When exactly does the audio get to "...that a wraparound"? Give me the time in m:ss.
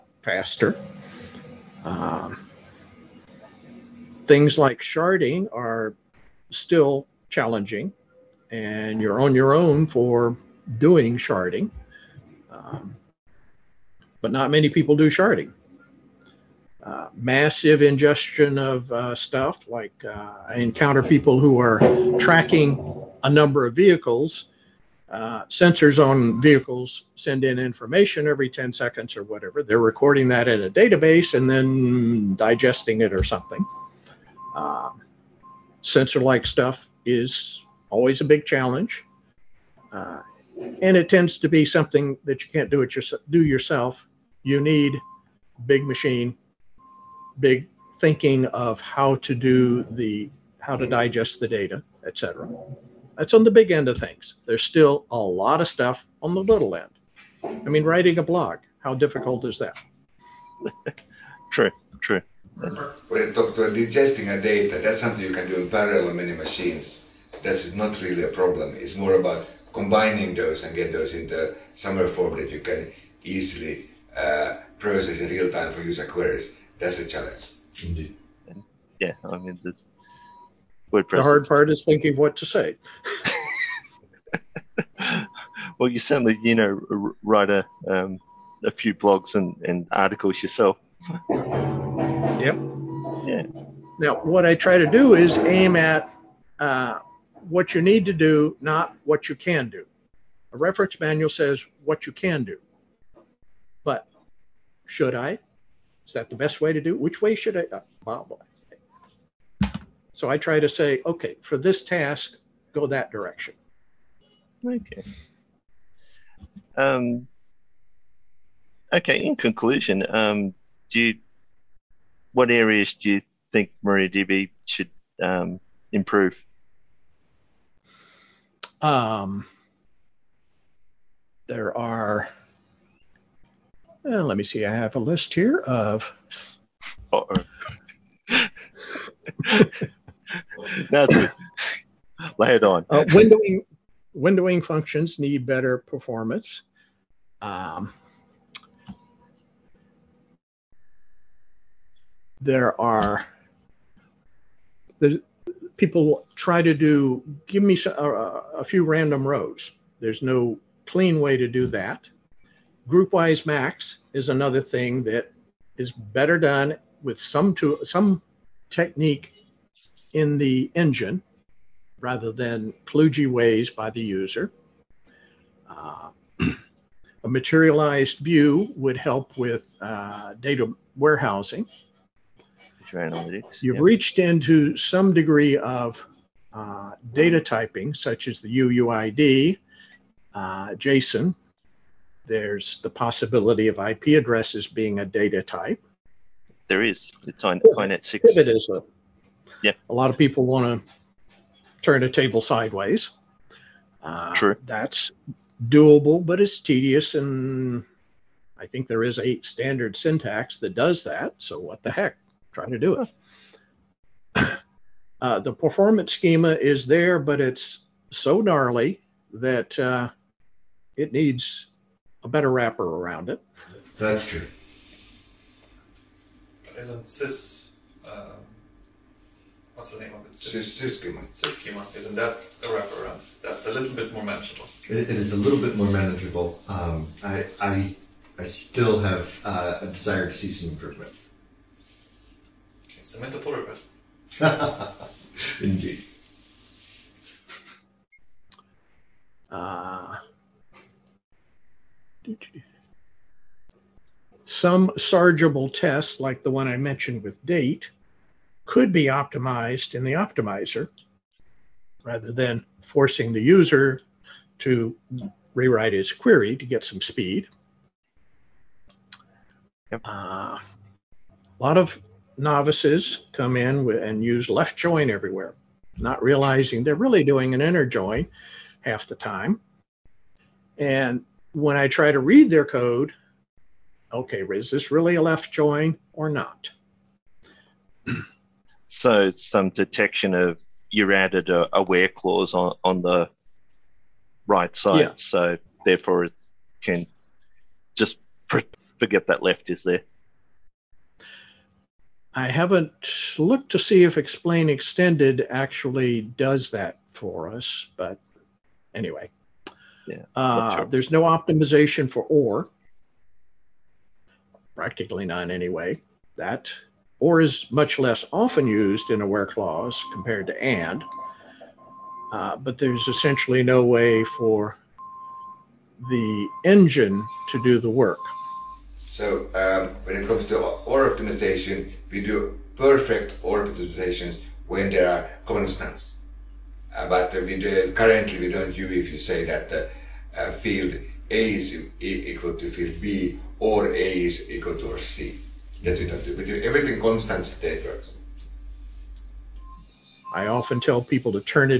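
3:52.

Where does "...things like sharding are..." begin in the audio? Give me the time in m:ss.
0:04.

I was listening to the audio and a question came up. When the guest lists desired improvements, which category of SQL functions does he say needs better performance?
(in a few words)
Windowing functions.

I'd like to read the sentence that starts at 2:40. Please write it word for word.
There's no clean way to do that.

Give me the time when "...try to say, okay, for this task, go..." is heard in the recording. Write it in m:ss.
1:50.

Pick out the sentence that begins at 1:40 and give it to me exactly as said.
A reference manual says what you can do.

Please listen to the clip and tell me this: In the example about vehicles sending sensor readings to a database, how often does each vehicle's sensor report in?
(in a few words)
Every 10 seconds.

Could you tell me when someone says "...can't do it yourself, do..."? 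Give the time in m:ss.
0:42.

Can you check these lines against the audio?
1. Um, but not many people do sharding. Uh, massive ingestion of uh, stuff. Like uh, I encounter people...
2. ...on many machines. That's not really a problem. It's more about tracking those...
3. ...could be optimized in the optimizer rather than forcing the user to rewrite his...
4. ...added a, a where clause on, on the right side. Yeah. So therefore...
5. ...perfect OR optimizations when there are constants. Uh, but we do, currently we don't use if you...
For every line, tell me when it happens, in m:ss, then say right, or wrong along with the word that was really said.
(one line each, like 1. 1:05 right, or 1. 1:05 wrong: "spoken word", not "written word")
1. 0:12 right
2. 1:06 wrong: "combining", not "tracking"
3. 4:18 right
4. 4:51 right
5. 5:32 right.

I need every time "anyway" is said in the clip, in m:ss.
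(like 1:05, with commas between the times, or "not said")
5:08, 5:15.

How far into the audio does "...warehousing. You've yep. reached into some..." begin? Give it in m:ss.
3:00.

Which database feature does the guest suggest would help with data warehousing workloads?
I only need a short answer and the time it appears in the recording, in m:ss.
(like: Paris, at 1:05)
A materialized view, at 2:57.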